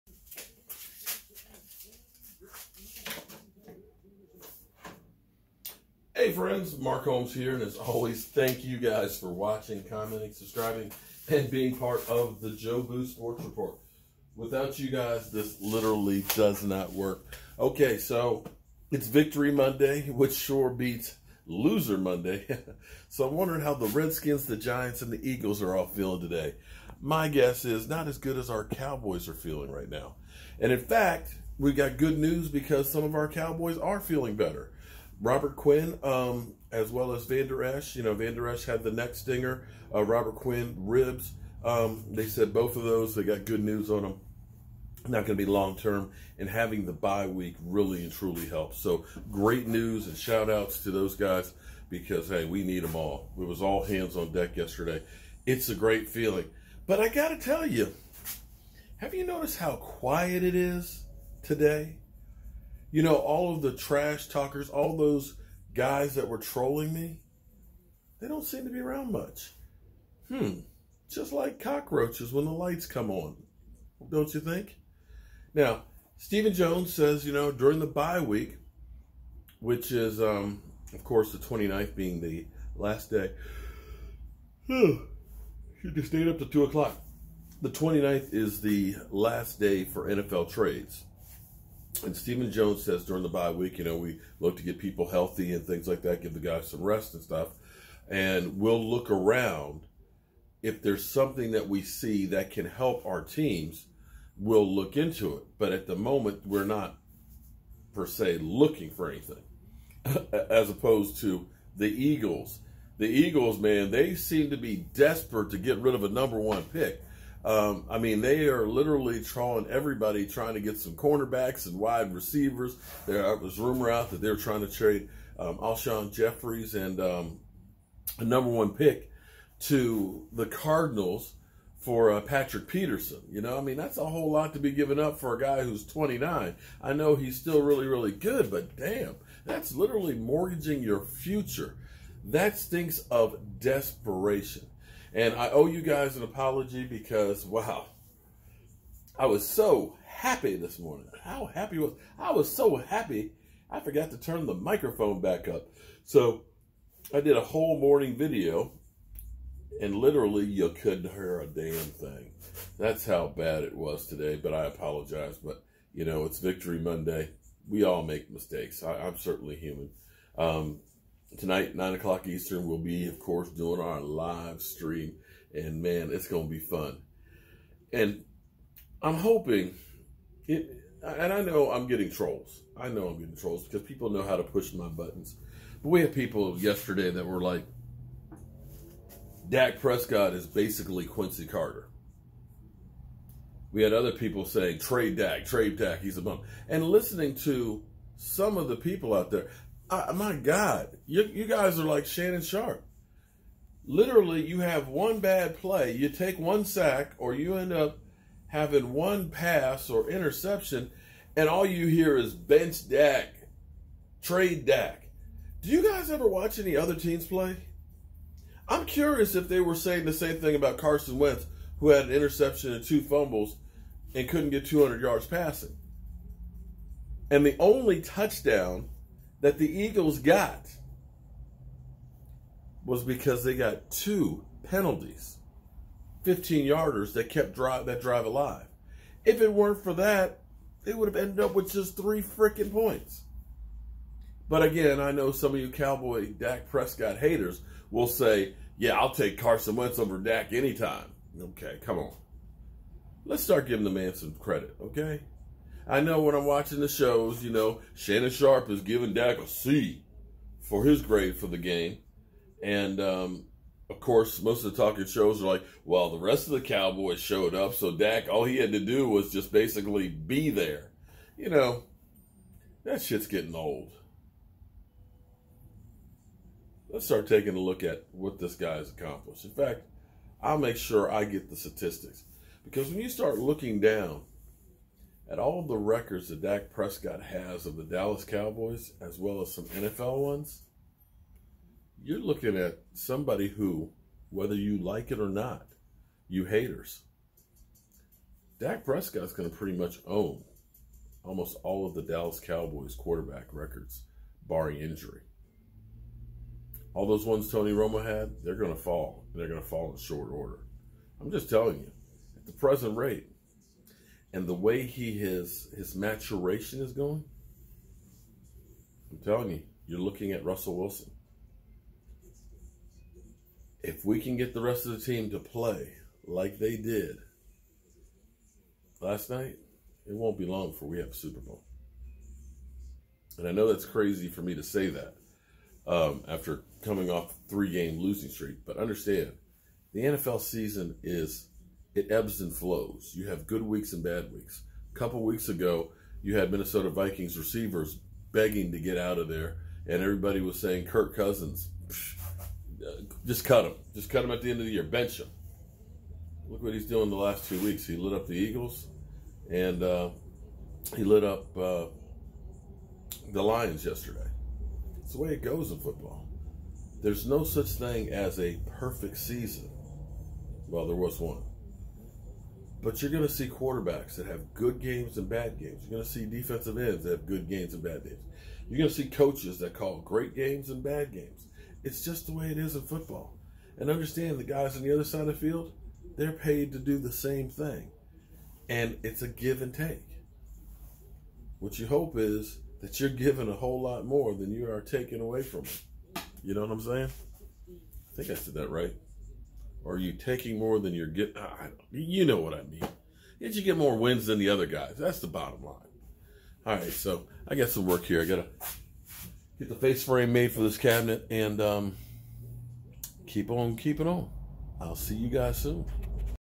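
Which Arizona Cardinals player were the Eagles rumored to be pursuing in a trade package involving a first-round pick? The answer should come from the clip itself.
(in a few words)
Patrick Peterson.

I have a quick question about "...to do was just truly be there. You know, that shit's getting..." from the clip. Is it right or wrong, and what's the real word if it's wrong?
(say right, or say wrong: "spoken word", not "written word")
wrong: "basically", not "truly".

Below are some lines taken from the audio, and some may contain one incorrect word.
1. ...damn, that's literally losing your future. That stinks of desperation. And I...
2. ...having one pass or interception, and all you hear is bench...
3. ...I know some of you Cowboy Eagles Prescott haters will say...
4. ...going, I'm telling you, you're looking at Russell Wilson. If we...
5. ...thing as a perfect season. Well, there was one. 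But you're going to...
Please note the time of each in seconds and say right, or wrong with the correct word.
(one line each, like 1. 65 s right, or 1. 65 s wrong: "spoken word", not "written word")
1. 138 s wrong: "mortgaging", not "losing"
2. 208 s right
3. 244 s wrong: "Dak", not "Eagles"
4. 316 s right
5. 367 s right.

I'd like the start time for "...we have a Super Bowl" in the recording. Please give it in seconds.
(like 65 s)
330 s.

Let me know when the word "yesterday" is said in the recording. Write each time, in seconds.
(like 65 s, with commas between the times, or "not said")
54 s, 186 s, 363 s.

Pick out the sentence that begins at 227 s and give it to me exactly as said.
And the only touchdown that the Eagles got was because they got two penalties, 15 yarders that kept drive that drive alive.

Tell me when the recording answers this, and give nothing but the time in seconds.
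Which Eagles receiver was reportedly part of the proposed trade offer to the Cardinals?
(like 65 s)
125 s.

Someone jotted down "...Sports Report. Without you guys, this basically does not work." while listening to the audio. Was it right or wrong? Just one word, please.
wrong.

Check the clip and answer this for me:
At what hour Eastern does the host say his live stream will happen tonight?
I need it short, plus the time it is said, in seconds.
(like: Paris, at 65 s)
9 o'clock, at 171 s.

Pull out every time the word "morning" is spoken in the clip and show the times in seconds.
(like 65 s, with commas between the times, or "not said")
150 s, 157 s.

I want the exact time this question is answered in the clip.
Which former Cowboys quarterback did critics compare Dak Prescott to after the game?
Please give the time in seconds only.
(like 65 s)
191 s.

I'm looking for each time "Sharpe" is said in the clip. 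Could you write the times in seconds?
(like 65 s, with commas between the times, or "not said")
202 s, 258 s.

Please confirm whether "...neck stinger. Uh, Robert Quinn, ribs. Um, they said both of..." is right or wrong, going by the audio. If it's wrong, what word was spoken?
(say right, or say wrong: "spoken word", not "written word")
right.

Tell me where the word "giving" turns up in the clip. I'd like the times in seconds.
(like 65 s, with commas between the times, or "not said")
253 s, 258 s, 393 s.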